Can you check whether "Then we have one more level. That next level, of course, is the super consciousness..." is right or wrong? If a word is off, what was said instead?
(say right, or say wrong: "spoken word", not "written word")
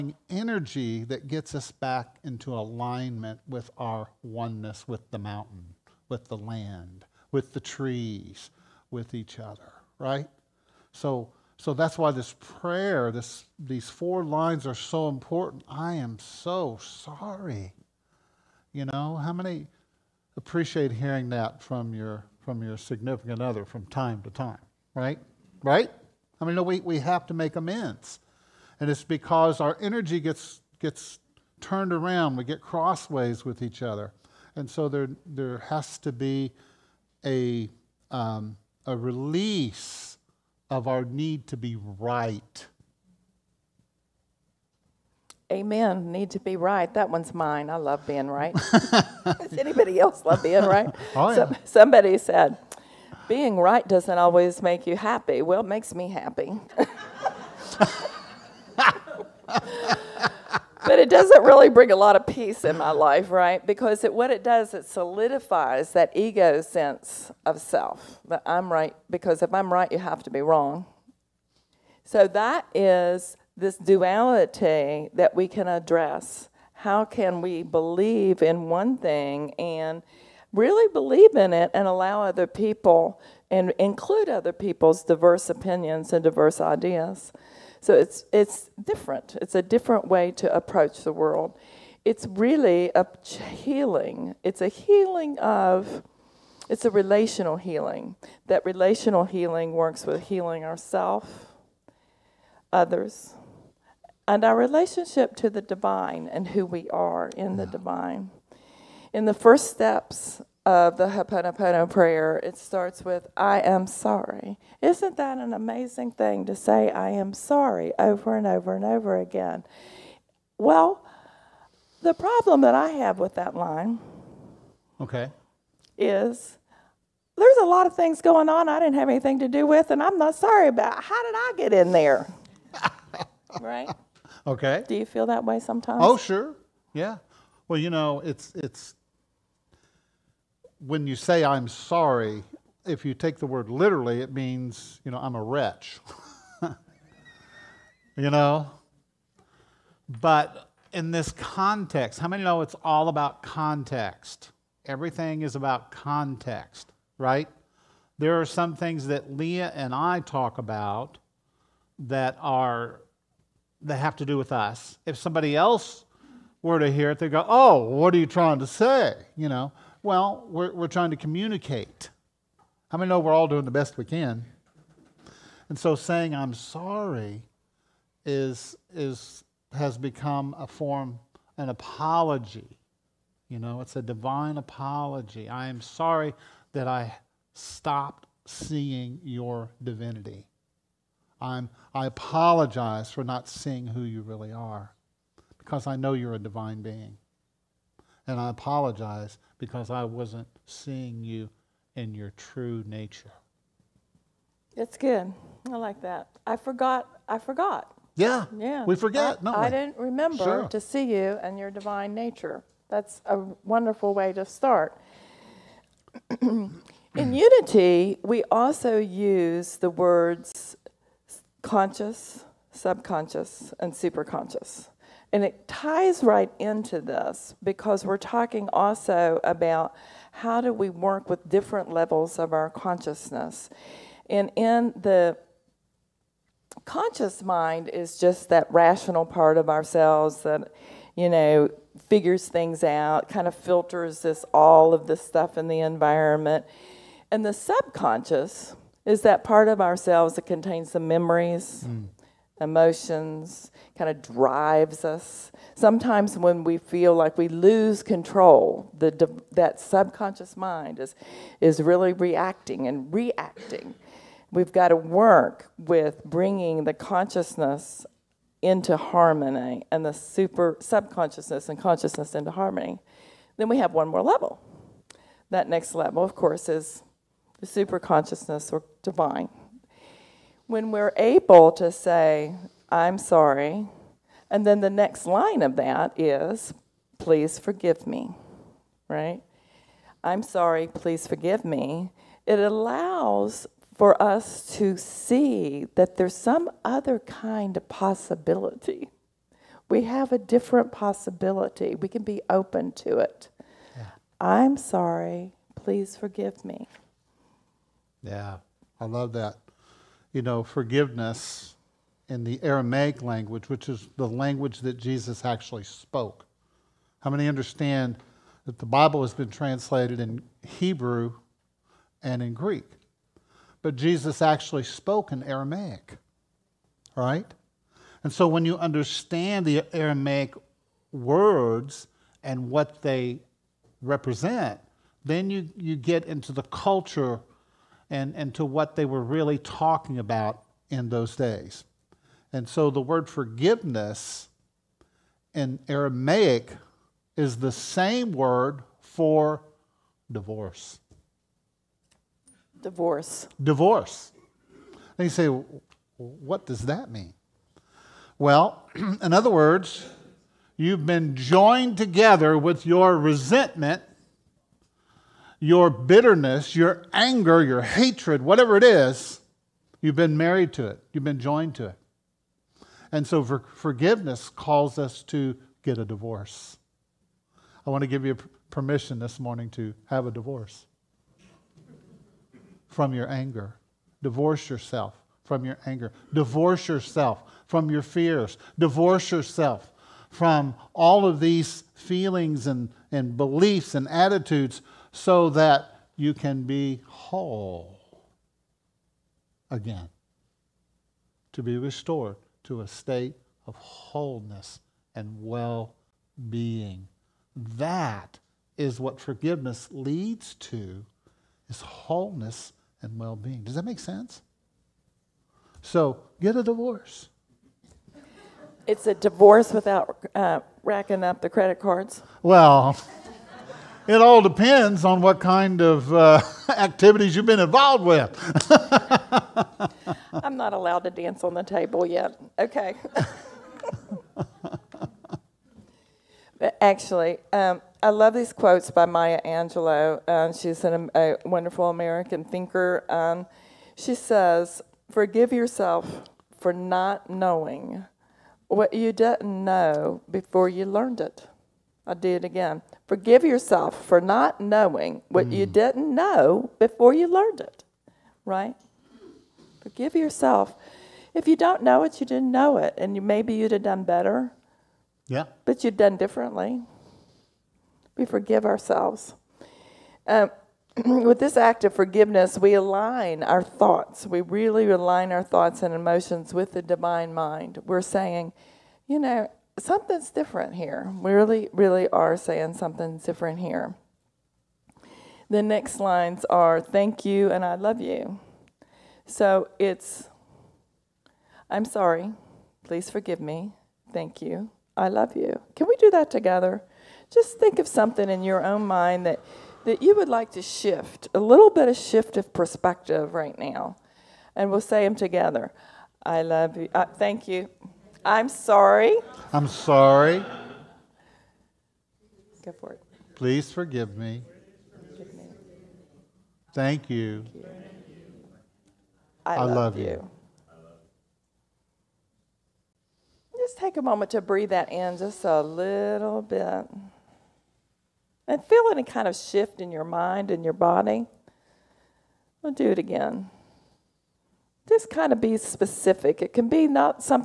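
right.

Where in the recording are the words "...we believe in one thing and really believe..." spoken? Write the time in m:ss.
1:17.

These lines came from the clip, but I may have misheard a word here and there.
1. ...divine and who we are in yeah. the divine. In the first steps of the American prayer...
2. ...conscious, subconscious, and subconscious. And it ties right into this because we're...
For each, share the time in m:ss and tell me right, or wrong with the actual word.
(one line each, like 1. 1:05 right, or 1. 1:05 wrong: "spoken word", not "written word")
1. 1:45 wrong: "Hoponopono", not "American"
2. 3:41 wrong: "superconscious", not "subconscious".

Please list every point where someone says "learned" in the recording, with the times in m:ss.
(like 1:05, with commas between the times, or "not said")
7:30, 7:37.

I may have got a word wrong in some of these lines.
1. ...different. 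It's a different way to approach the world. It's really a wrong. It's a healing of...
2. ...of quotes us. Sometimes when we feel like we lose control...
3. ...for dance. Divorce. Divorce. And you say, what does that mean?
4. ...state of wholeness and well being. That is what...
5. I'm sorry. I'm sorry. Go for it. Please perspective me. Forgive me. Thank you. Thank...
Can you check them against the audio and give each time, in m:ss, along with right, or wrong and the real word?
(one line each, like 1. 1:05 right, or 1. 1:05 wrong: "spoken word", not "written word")
1. 1:28 wrong: "healing", not "wrong"
2. 4:14 wrong: "drives", not "quotes"
3. 5:48 wrong: "divorce", not "dance"
4. 6:42 right
5. 8:28 wrong: "forgive", not "perspective".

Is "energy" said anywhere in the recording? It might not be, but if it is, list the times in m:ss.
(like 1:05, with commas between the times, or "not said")
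0:00, 0:29.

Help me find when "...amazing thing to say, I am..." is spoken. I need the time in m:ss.
1:55.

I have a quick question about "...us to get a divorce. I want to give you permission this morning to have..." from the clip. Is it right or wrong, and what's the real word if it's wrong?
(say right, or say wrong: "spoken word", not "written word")
right.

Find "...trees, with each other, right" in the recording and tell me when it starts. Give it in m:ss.
0:07.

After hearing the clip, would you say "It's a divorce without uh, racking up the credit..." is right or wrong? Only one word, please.
right.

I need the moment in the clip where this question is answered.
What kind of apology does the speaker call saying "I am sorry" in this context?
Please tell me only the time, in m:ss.
3:04.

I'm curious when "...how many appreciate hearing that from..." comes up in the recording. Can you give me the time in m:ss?
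0:19.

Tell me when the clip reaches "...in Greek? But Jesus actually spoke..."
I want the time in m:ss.
5:22.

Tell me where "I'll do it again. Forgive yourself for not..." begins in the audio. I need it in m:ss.
7:32.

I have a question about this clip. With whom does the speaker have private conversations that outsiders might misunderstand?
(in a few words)
Leah.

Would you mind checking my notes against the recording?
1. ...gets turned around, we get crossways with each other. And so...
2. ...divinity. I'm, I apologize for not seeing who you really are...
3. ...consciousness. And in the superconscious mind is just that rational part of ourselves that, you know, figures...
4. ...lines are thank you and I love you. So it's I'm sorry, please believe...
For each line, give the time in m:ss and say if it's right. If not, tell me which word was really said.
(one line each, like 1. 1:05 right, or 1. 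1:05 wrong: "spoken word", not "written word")
1. 0:30 right
2. 3:09 right
3. 3:52 wrong: "conscious", not "superconscious"
4. 8:05 wrong: "forgive", not "believe".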